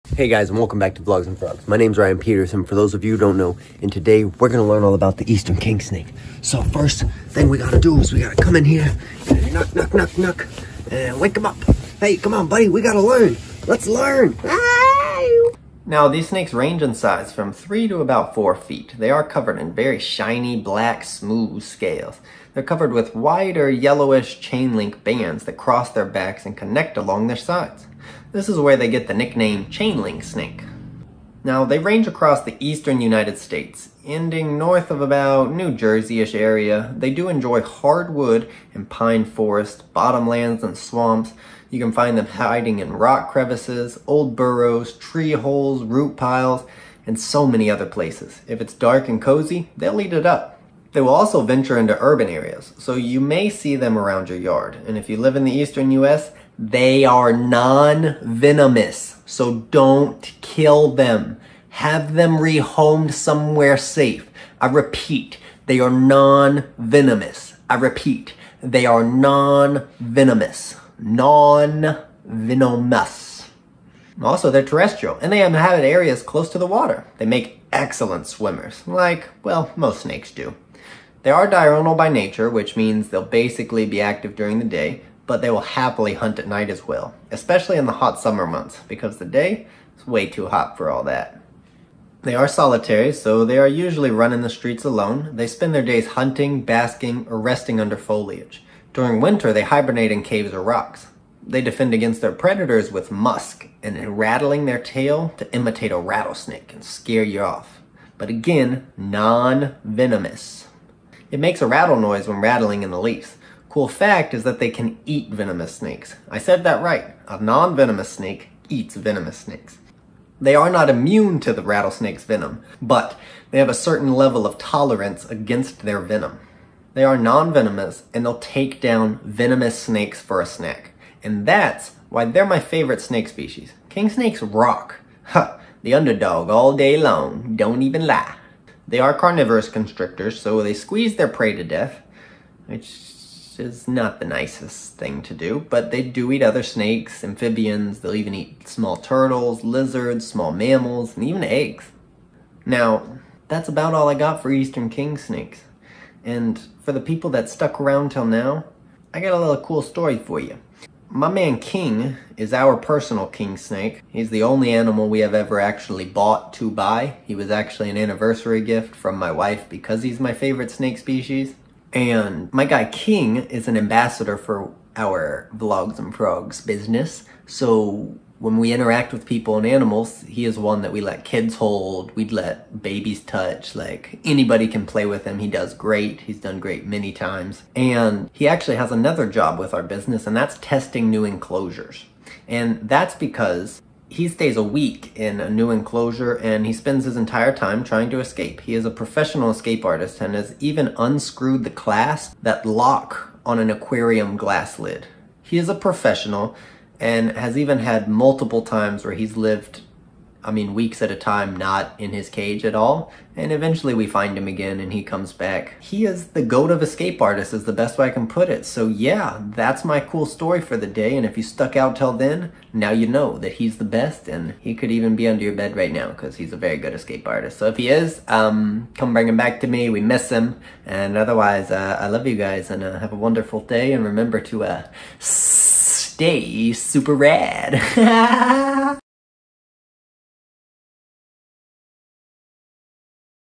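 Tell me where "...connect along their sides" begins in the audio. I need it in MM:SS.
00:26.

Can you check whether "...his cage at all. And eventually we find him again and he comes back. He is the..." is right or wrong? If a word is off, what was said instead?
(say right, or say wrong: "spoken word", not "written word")
right.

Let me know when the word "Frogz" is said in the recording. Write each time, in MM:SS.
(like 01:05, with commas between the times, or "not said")
00:01, 02:56.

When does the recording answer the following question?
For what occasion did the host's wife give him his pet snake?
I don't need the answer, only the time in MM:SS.
02:47.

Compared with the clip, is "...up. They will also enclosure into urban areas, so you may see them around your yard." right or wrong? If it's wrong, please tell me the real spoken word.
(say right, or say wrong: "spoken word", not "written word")
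wrong: "venture", not "enclosure".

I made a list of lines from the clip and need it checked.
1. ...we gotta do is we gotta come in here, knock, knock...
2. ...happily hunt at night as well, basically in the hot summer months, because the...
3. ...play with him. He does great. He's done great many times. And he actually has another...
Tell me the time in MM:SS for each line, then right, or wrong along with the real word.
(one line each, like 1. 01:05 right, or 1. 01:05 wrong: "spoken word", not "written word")
1. 00:07 right
2. 01:25 wrong: "especially", not "basically"
3. 03:04 right.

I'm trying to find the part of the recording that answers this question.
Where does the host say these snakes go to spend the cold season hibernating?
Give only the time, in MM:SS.
01:40.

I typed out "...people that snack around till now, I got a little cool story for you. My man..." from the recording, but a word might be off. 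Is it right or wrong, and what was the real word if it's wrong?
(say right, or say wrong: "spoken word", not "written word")
wrong: "stuck", not "snack".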